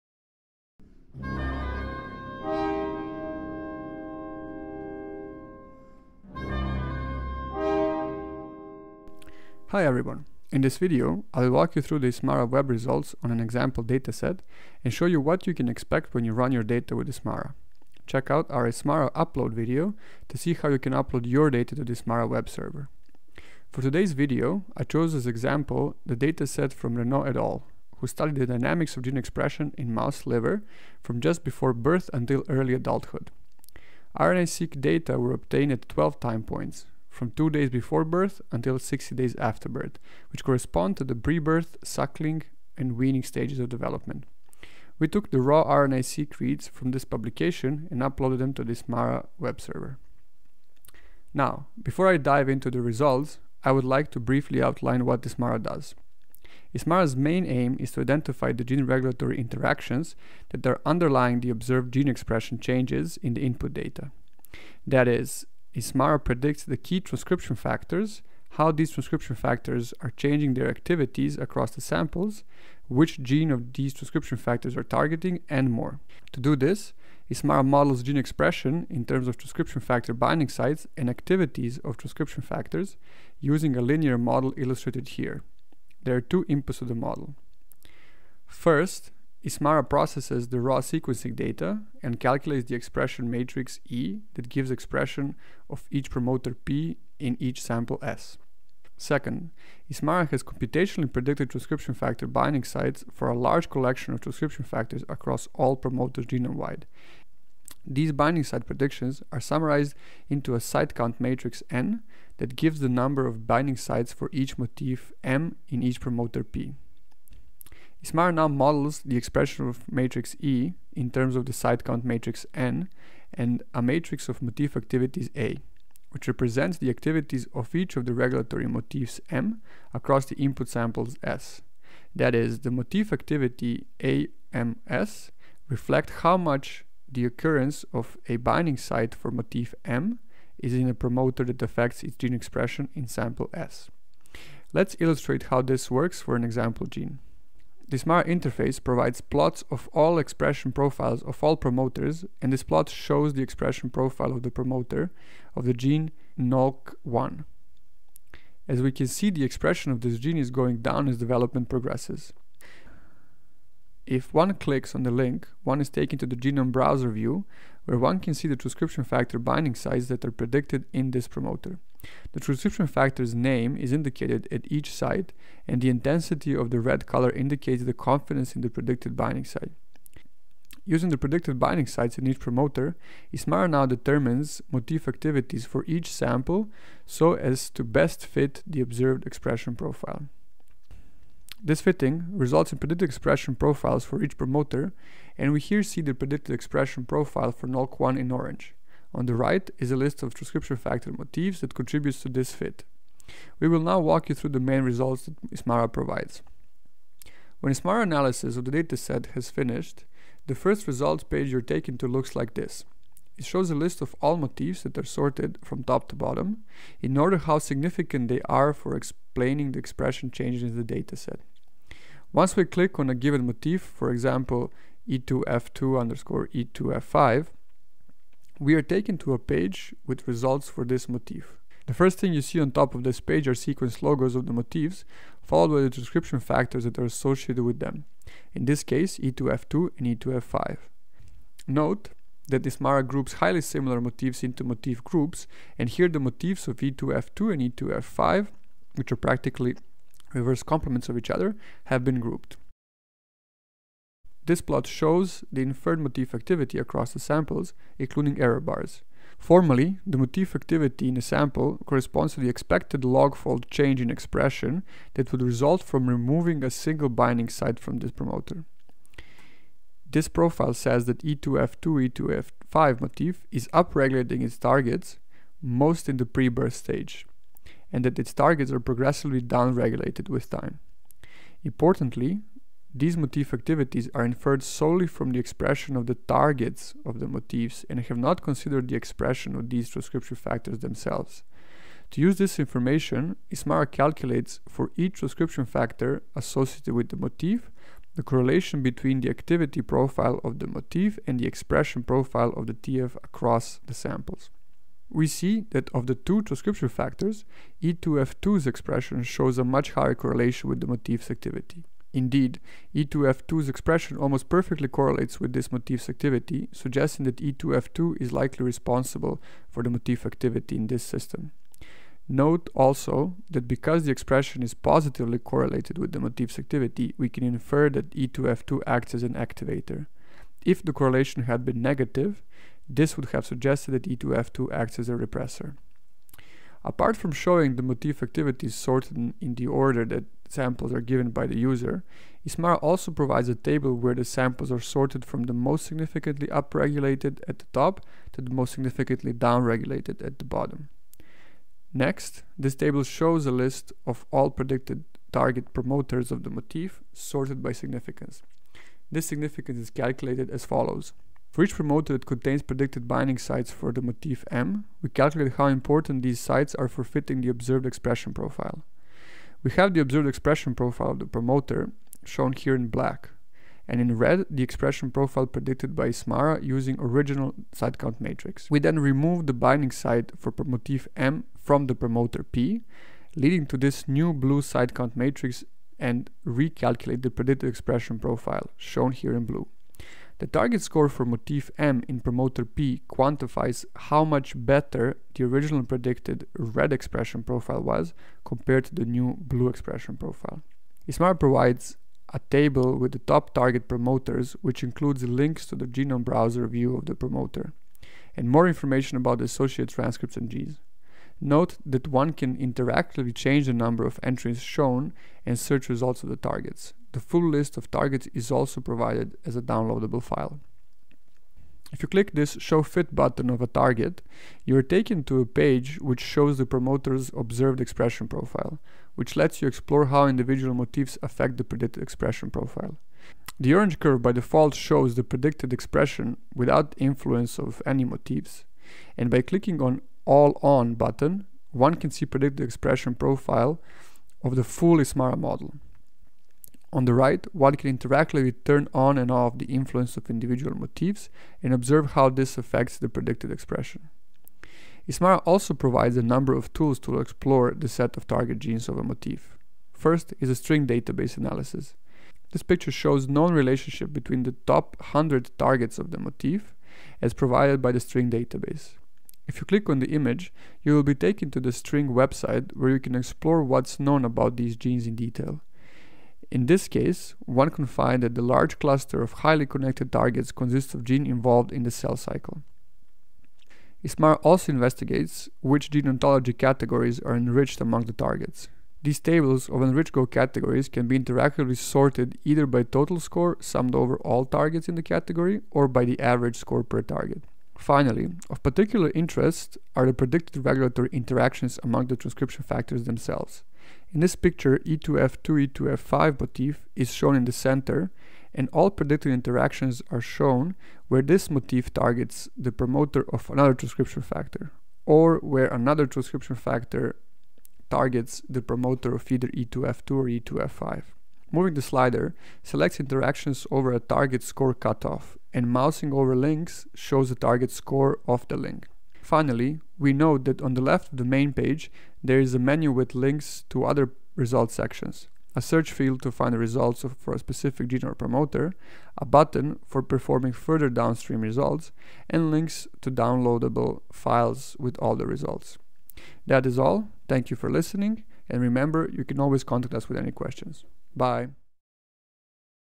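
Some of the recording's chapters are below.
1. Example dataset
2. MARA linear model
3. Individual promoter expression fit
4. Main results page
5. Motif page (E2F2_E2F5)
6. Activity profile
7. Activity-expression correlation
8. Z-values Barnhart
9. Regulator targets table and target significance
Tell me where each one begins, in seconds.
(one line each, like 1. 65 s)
1. 23 s
2. 50 s
3. 143 s
4. 203 s
5. 221 s
6. 252 s
7. 290 s
8. 336 s
9. 350 s.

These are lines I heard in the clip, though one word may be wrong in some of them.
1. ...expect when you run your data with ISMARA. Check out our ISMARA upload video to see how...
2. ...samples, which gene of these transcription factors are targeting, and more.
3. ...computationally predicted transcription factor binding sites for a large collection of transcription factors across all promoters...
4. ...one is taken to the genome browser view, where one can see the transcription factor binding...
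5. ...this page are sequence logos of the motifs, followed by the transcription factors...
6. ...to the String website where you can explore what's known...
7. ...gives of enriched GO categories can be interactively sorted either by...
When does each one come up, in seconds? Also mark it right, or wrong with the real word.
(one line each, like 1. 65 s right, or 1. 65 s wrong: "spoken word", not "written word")
1. 15 s right
2. 71 s right
3. 100 s right
4. 165 s right
5. 233 s right
6. 471 s right
7. 489 s wrong: "tables", not "gives".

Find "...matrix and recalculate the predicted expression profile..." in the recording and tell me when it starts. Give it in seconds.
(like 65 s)
385 s.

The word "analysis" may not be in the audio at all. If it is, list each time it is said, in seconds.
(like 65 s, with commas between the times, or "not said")
208 s, 461 s.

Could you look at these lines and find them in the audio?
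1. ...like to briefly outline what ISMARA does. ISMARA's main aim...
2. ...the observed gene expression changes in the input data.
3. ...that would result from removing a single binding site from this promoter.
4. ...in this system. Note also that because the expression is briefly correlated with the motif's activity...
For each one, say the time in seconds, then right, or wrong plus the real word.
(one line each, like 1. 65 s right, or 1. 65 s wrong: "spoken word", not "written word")
1. 53 s right
2. 61 s right
3. 265 s right
4. 320 s wrong: "positively", not "briefly".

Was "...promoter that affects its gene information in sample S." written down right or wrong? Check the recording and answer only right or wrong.
wrong.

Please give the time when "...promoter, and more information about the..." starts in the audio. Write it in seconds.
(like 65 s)
407 s.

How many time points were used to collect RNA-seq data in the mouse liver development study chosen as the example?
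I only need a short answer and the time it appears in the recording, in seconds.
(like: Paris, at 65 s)
12, at 35 s.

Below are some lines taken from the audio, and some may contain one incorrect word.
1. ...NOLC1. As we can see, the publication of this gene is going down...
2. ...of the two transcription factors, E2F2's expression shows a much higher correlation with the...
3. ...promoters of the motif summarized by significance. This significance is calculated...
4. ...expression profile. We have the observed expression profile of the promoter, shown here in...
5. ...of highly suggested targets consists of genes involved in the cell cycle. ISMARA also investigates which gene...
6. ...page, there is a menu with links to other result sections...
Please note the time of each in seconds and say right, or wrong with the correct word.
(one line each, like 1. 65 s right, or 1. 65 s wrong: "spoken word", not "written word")
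1. 156 s wrong: "expression", not "publication"
2. 305 s right
3. 355 s wrong: "sorted", not "summarized"
4. 367 s right
5. 479 s wrong: "connected", not "suggested"
6. 531 s right.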